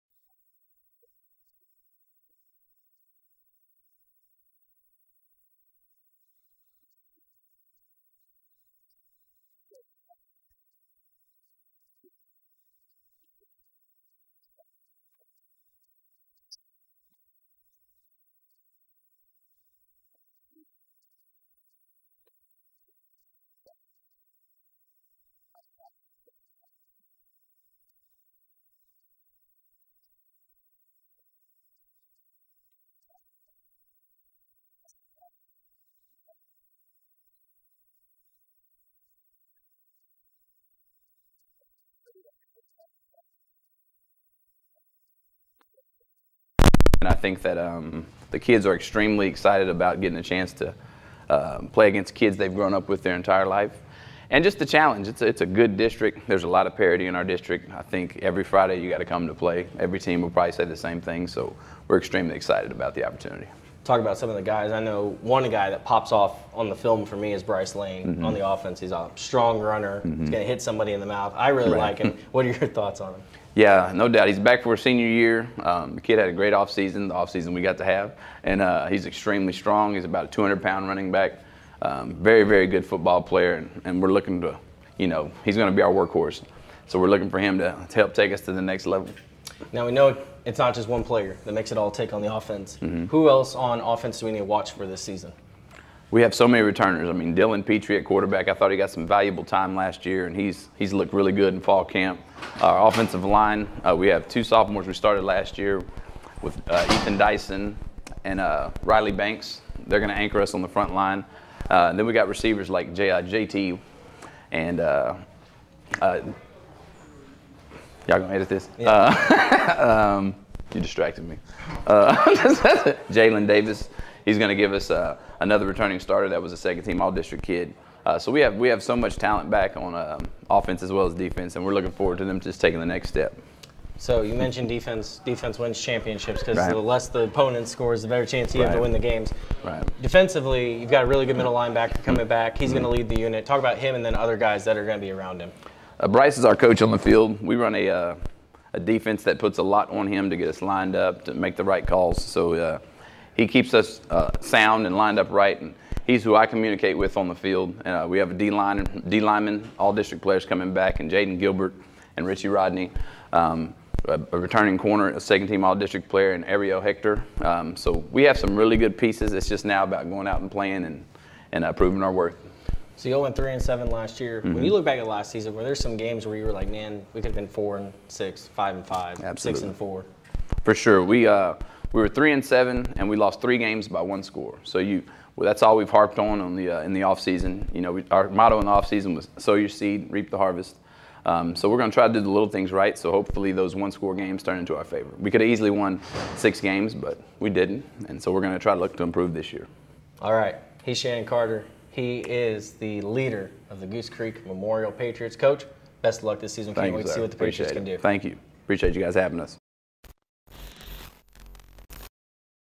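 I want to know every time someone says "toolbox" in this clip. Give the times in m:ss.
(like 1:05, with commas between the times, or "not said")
not said.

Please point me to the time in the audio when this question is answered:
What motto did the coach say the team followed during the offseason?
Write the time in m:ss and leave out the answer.
3:09.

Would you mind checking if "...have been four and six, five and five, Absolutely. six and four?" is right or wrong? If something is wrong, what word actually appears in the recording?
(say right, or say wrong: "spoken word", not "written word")
right.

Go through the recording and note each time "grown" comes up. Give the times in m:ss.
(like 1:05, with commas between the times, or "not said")
0:52.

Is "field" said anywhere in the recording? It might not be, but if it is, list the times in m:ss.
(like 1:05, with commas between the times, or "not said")
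2:26, 2:37.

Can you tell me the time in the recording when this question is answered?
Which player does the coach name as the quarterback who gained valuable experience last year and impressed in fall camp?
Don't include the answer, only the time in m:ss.
1:37.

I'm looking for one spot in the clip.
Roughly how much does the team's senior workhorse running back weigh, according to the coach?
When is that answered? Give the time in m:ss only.
1:20.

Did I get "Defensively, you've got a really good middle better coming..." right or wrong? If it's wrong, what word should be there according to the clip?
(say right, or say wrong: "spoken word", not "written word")
wrong: "linebacker", not "better".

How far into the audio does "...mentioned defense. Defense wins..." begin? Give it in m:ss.
2:14.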